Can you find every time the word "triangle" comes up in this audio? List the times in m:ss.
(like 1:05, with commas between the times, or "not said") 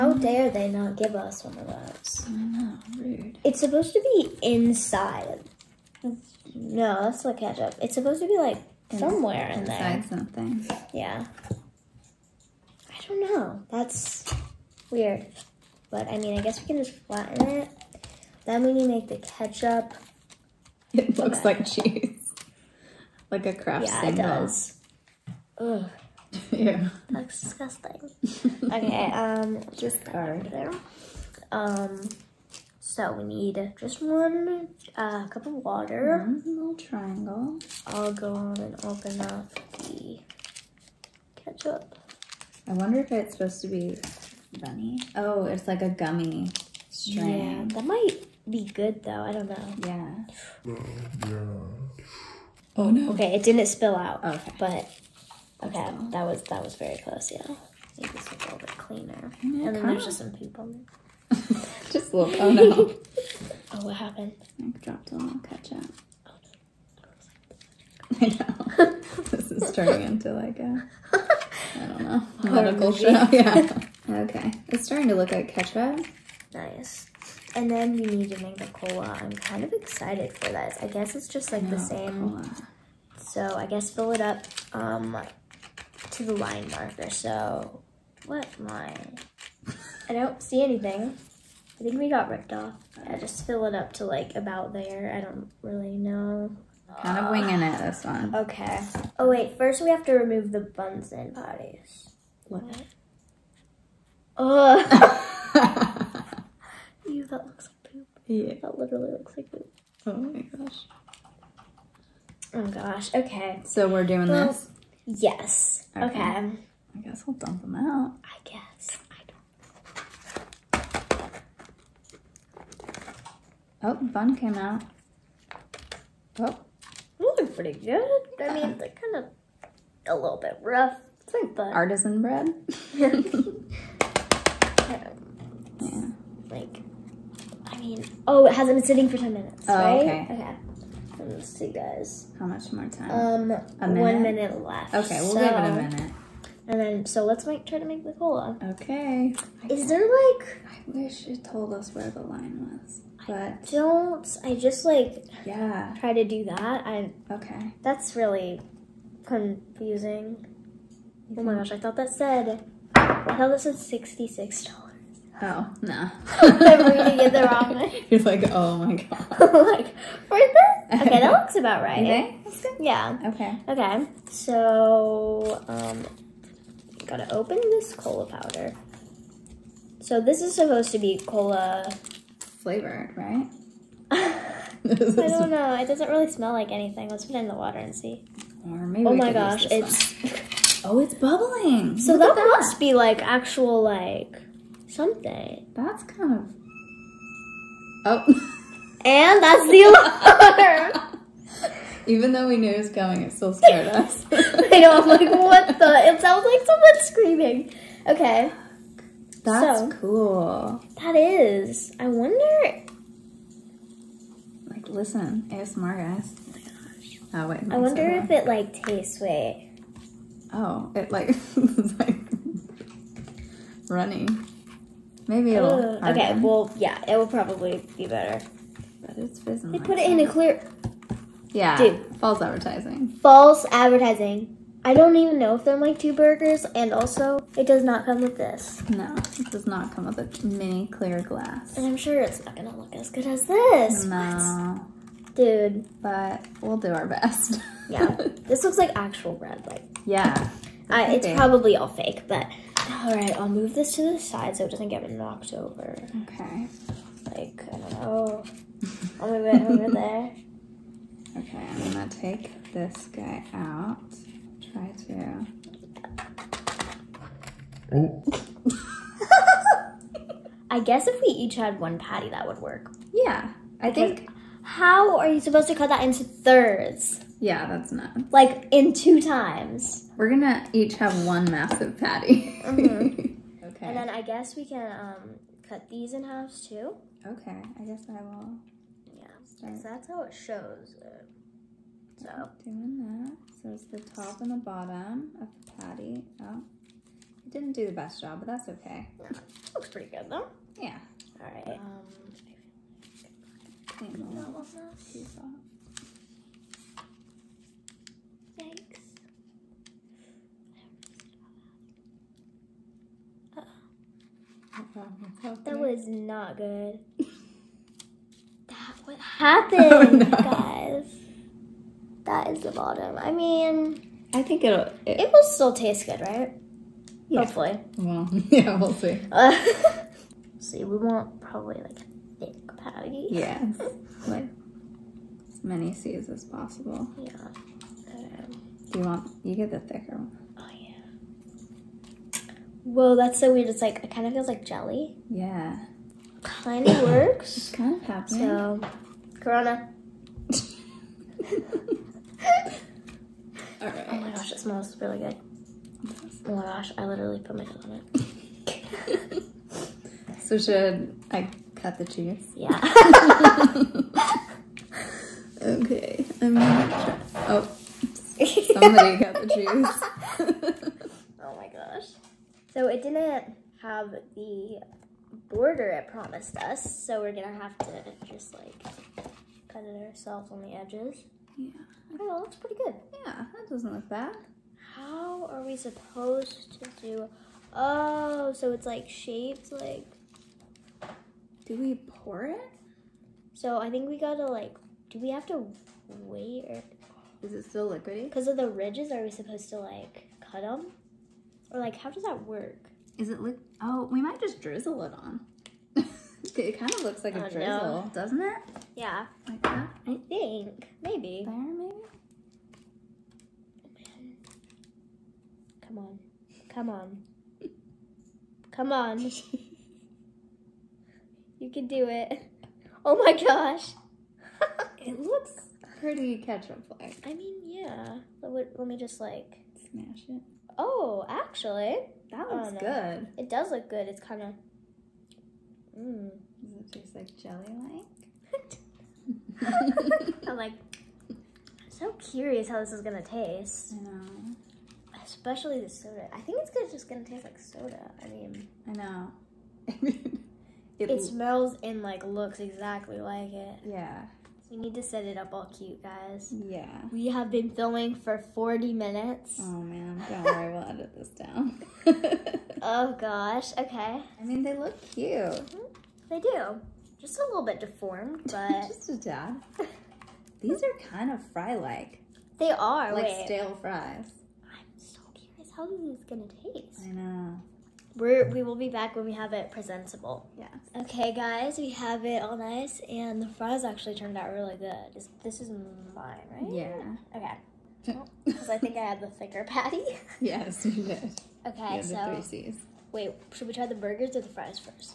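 0:36.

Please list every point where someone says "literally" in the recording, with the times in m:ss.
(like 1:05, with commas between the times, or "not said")
1:48, 5:57.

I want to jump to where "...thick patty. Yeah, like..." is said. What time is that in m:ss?
5:32.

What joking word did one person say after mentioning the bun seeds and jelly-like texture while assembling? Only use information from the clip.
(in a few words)
Corona.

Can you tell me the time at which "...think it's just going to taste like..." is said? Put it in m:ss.
7:26.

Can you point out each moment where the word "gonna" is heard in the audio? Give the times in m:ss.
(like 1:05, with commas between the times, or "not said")
4:02, 4:21, 4:40, 6:06, 6:17.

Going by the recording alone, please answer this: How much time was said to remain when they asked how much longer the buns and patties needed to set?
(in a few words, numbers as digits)
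1 minute.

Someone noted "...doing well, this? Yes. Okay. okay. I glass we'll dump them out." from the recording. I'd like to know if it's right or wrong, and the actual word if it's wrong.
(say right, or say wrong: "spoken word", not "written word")
wrong: "guess", not "glass".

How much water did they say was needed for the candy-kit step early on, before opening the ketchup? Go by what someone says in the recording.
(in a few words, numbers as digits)
1 cup.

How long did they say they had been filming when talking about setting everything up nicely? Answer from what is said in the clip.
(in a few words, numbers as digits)
40 minutes.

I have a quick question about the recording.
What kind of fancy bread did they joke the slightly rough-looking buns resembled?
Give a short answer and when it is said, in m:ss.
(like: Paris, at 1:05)
artisan bread, at 2:11.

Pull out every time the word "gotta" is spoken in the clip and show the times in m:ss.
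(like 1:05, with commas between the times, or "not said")
2:57, 6:34.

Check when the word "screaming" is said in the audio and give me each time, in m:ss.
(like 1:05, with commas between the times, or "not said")
3:26.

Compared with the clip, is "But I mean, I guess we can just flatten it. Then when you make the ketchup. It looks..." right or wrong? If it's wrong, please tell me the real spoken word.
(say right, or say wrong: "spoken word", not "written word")
right.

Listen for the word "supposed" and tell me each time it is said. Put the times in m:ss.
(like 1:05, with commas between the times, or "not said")
0:03, 0:07, 0:43, 3:00, 4:35, 6:25, 6:39.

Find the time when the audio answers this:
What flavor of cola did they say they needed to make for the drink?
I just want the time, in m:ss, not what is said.
1:18.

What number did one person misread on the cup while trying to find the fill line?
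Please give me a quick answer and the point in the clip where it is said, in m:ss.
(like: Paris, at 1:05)
66, at 2:43.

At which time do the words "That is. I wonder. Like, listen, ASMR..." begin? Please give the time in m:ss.
3:30.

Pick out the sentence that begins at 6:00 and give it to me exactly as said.
so should I cut the cheese?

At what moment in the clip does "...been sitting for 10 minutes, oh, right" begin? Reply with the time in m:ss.
2:18.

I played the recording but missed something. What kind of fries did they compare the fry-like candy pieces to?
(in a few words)
stale fries.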